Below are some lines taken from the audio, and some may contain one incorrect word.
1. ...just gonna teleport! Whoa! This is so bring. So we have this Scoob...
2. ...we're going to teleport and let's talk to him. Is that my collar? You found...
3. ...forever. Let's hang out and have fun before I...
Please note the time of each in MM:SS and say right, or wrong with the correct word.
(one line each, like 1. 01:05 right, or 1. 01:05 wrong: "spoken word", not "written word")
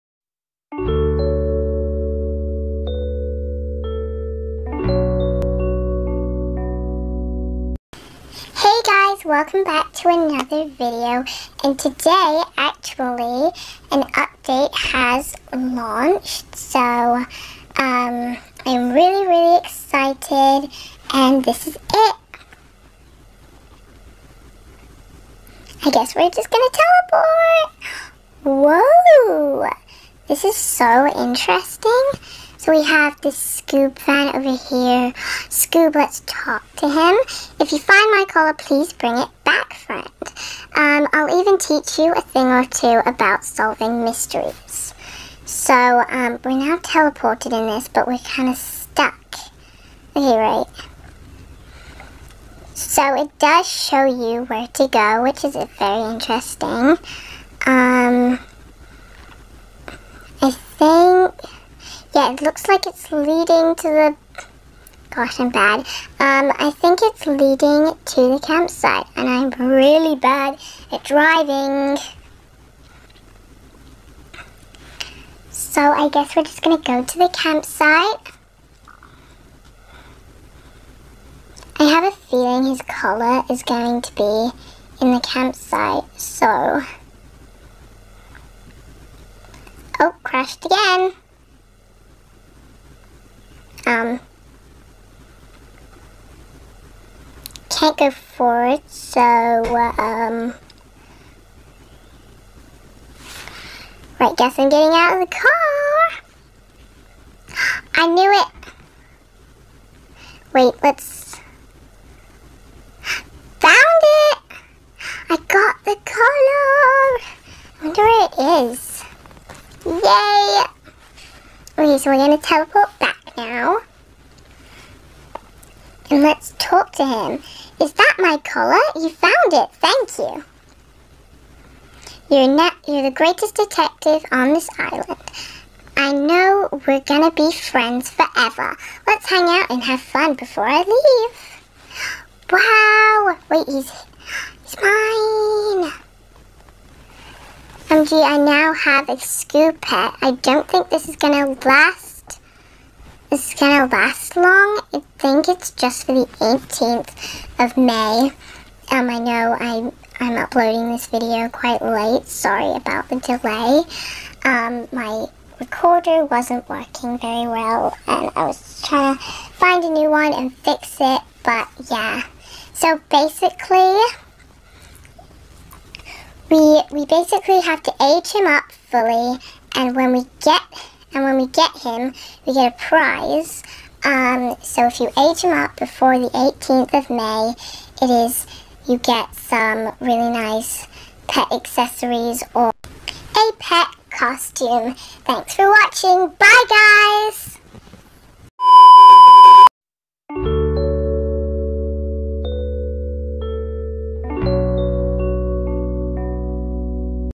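1. 00:26 wrong: "interesting", not "bring"
2. 02:02 right
3. 02:18 right.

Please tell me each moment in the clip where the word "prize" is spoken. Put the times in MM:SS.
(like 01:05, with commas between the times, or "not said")
03:02.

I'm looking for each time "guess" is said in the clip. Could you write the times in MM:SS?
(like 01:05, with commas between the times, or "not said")
00:25, 01:16, 01:44.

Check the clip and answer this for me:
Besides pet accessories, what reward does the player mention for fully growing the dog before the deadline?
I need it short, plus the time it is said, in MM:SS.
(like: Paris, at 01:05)
pet costume, at 03:13.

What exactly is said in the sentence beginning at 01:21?
I have a feeling his collar is going to be in the campsite, so...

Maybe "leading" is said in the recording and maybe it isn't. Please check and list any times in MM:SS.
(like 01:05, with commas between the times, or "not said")
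01:03, 01:07.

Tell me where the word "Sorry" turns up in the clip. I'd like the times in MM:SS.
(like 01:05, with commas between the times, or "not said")
02:42.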